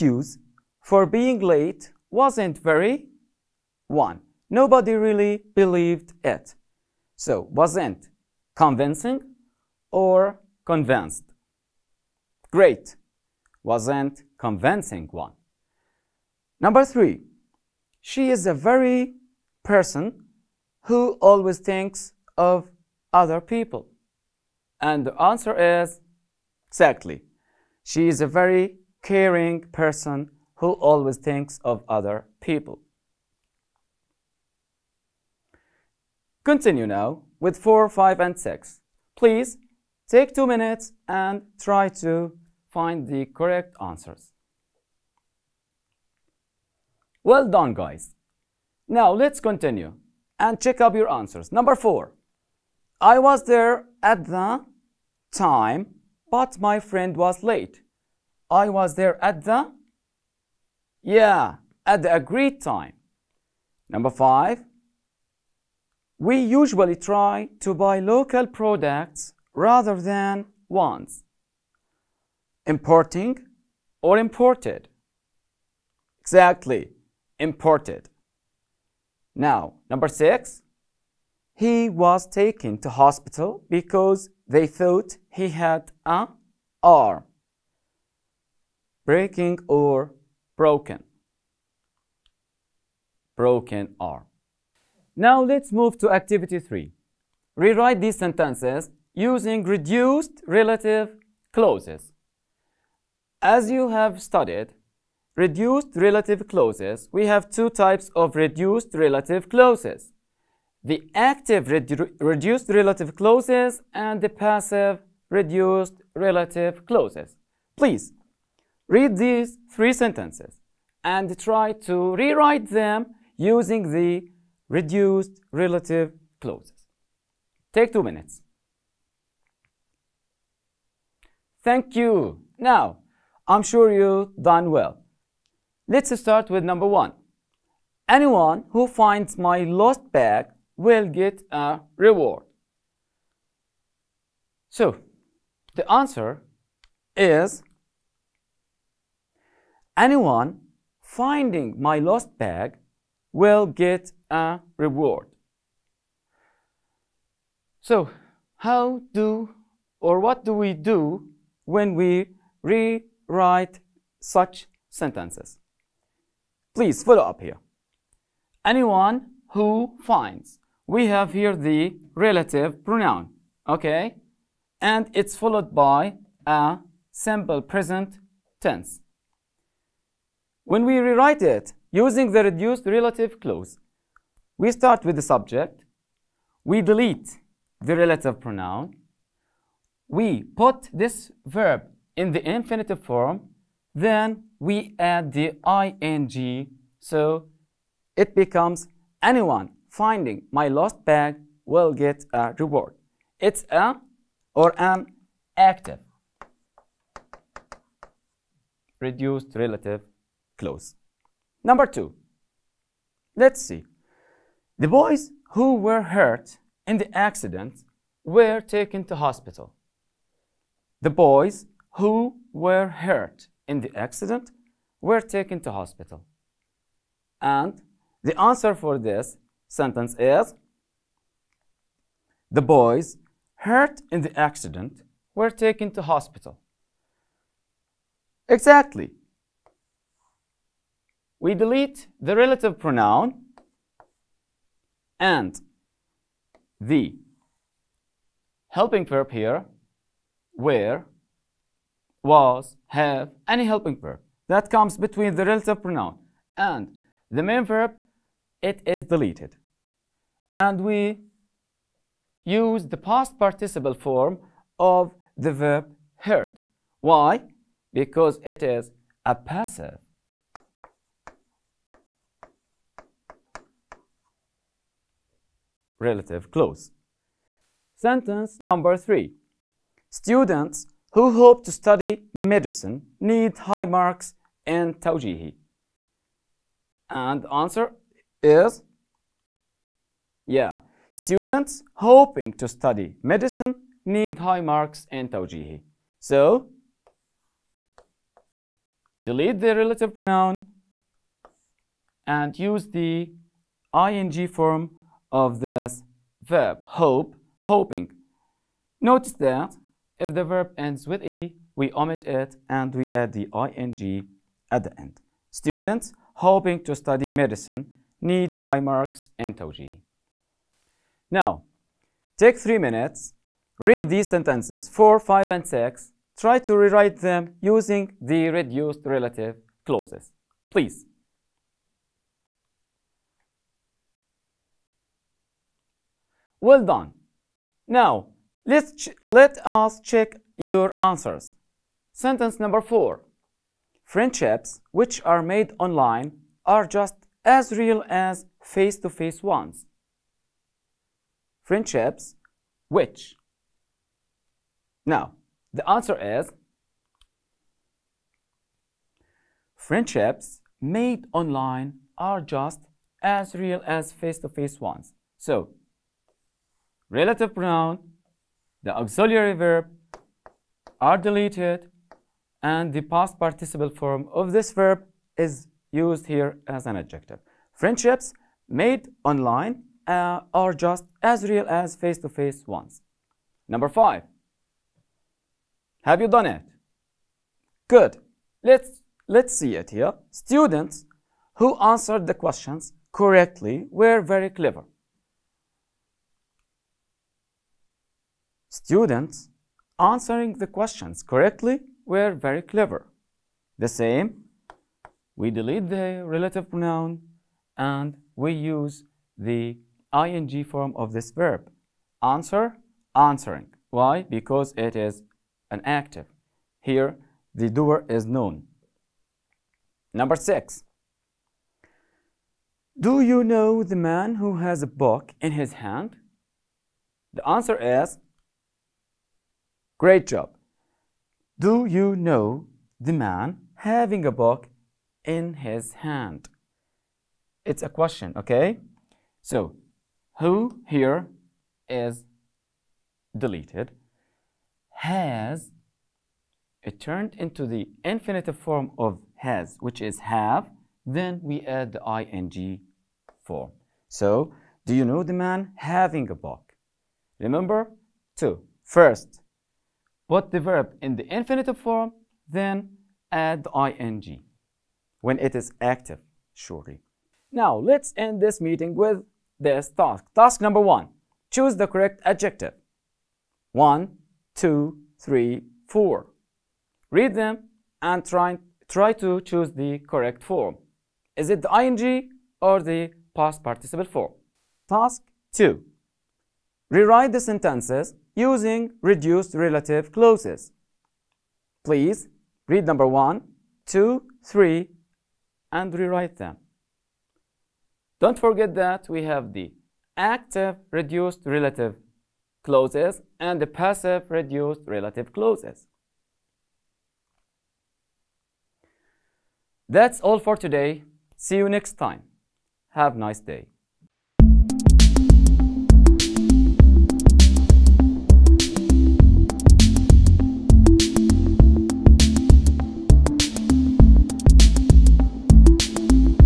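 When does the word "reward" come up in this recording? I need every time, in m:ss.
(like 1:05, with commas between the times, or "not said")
2:21, 2:34, 3:22.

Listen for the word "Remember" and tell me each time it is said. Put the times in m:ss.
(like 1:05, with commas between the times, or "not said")
7:37.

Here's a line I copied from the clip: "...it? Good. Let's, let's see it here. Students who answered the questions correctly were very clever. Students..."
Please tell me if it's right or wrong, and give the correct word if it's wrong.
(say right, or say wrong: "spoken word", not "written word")
right.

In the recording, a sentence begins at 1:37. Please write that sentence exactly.
Rewrite these sentences using reduced relative clauses.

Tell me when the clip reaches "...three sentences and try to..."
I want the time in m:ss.
1:59.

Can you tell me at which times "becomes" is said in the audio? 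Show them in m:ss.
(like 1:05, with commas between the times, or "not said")
3:18.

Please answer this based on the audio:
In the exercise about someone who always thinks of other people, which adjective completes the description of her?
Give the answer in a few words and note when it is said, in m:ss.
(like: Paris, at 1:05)
caring, at 0:29.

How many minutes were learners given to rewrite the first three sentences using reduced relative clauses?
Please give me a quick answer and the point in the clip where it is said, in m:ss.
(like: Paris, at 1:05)
two minutes, at 2:07.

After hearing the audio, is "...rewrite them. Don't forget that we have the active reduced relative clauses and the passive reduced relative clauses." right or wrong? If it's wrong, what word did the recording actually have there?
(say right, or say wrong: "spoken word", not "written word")
right.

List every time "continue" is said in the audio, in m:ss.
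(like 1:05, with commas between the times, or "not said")
0:36, 0:49.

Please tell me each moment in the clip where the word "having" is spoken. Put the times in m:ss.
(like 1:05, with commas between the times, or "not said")
7:13, 7:35.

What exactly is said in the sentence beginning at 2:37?
So, how do or what do we do when we rewrite such sentences?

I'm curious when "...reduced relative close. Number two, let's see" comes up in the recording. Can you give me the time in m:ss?
3:29.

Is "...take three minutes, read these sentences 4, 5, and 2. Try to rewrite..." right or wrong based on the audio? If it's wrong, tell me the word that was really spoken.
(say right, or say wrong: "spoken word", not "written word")
wrong: "6", not "2".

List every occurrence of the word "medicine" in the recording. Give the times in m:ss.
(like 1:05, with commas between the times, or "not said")
4:42, 4:53, 5:17.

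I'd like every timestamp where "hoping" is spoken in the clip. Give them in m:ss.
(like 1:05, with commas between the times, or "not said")
4:51, 5:07, 5:16.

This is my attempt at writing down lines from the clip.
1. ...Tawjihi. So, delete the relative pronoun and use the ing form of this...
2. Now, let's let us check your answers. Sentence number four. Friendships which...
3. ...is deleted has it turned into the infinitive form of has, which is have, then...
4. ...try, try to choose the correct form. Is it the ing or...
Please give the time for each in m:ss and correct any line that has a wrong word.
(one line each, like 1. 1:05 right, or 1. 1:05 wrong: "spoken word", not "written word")
1. 4:55 right
2. 5:37 right
3. 7:21 right
4. 7:58 right.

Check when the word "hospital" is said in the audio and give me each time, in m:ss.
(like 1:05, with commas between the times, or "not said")
1:22, 3:39, 3:45, 3:56.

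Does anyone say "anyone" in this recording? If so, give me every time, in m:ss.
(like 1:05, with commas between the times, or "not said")
2:18, 2:29, 2:48, 3:19.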